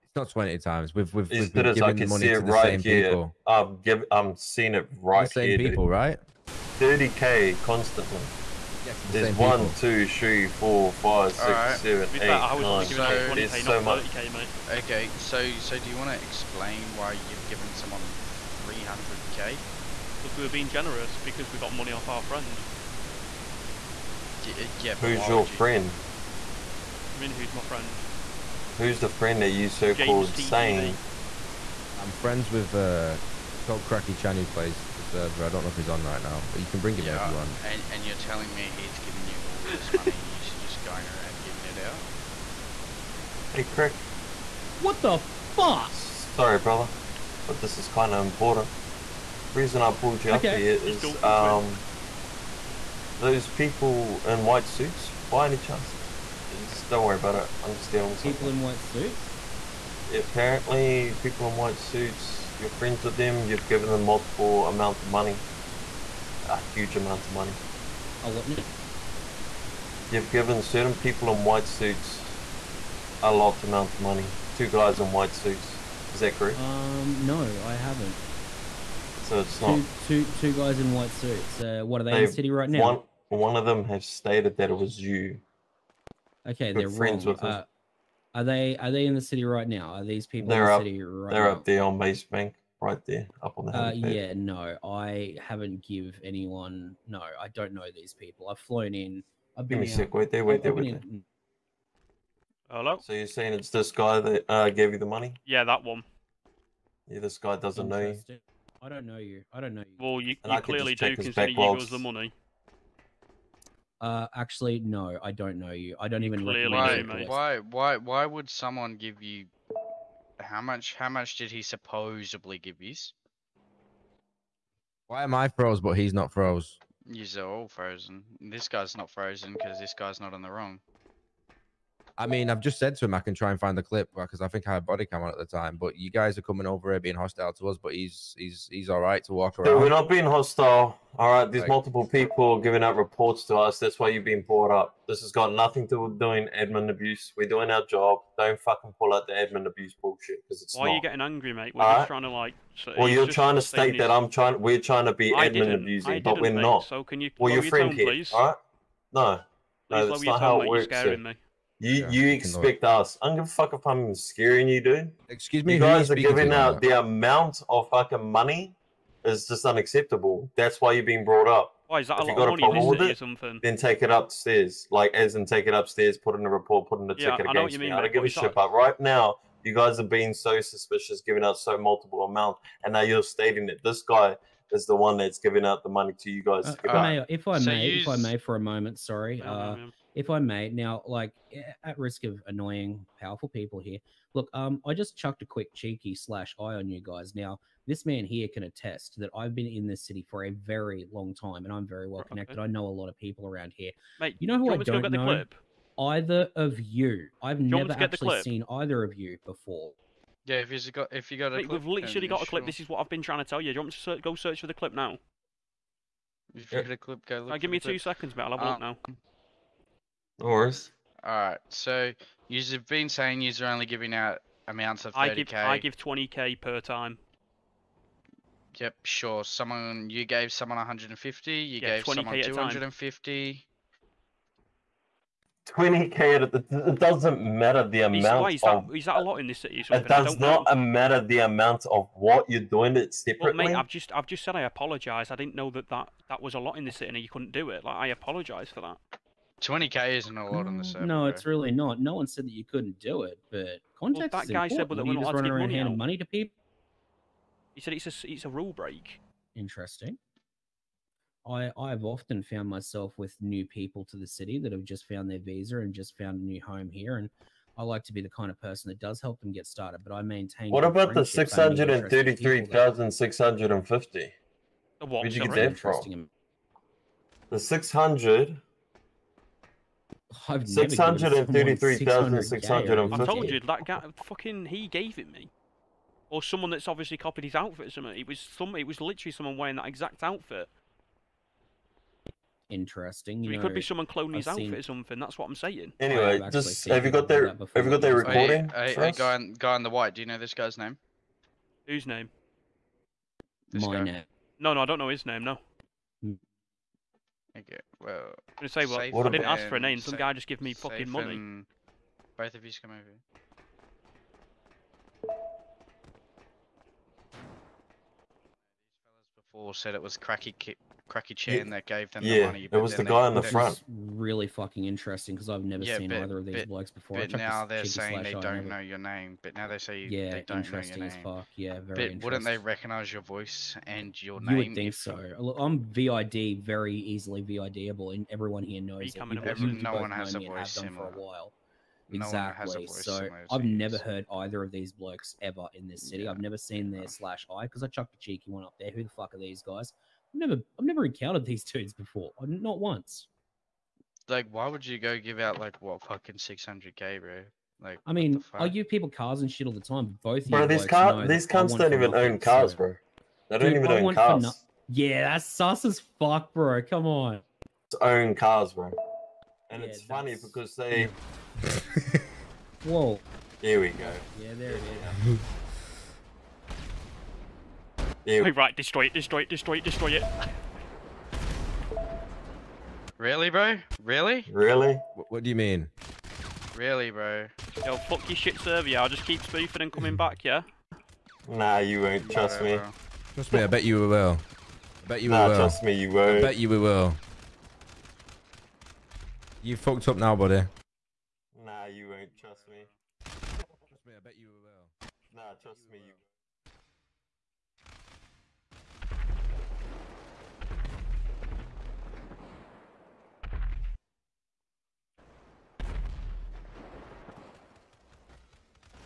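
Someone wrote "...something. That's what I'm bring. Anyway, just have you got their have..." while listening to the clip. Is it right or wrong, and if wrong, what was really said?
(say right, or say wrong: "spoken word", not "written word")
wrong: "saying", not "bring".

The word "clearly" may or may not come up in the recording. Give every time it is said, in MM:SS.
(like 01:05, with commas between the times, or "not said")
01:50, 01:56.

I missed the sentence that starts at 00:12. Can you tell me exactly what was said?
Giving so, twenty k, so not thirty k, mate.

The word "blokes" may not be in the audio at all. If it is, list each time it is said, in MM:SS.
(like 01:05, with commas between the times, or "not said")
05:26, 05:44.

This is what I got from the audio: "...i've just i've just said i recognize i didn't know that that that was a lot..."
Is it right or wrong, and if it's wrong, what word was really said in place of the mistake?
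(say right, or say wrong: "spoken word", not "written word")
wrong: "apologize", not "recognize".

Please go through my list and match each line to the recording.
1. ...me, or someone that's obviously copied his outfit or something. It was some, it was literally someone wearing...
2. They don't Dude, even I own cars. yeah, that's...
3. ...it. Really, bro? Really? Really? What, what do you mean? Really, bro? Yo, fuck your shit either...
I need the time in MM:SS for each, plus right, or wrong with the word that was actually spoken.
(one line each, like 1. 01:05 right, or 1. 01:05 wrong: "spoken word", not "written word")
1. 04:45 right
2. 06:03 right
3. 06:20 wrong: "server", not "either".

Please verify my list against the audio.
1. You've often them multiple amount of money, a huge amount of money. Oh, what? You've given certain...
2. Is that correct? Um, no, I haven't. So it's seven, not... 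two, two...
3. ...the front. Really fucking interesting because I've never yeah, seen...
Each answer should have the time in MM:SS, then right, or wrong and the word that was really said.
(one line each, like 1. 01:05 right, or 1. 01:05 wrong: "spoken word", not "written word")
1. 01:03 wrong: "given", not "often"
2. 01:16 wrong: "two", not "seven"
3. 05:23 right.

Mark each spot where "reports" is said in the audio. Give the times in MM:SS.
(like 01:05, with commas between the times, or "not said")
02:22, 02:56.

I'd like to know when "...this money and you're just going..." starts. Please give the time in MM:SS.
00:39.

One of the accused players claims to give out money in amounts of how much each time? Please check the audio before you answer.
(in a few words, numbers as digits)
20k.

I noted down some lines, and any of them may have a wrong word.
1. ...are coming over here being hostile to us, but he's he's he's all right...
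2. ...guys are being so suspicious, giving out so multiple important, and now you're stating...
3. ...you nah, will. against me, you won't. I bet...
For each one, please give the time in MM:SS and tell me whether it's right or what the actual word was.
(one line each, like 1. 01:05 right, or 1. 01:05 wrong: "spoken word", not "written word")
1. 02:16 right
2. 02:59 wrong: "amount", not "important"
3. 06:35 wrong: "trust", not "against".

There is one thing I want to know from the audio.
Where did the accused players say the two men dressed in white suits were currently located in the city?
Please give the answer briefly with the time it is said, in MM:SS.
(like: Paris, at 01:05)
Base Bank, at 01:31.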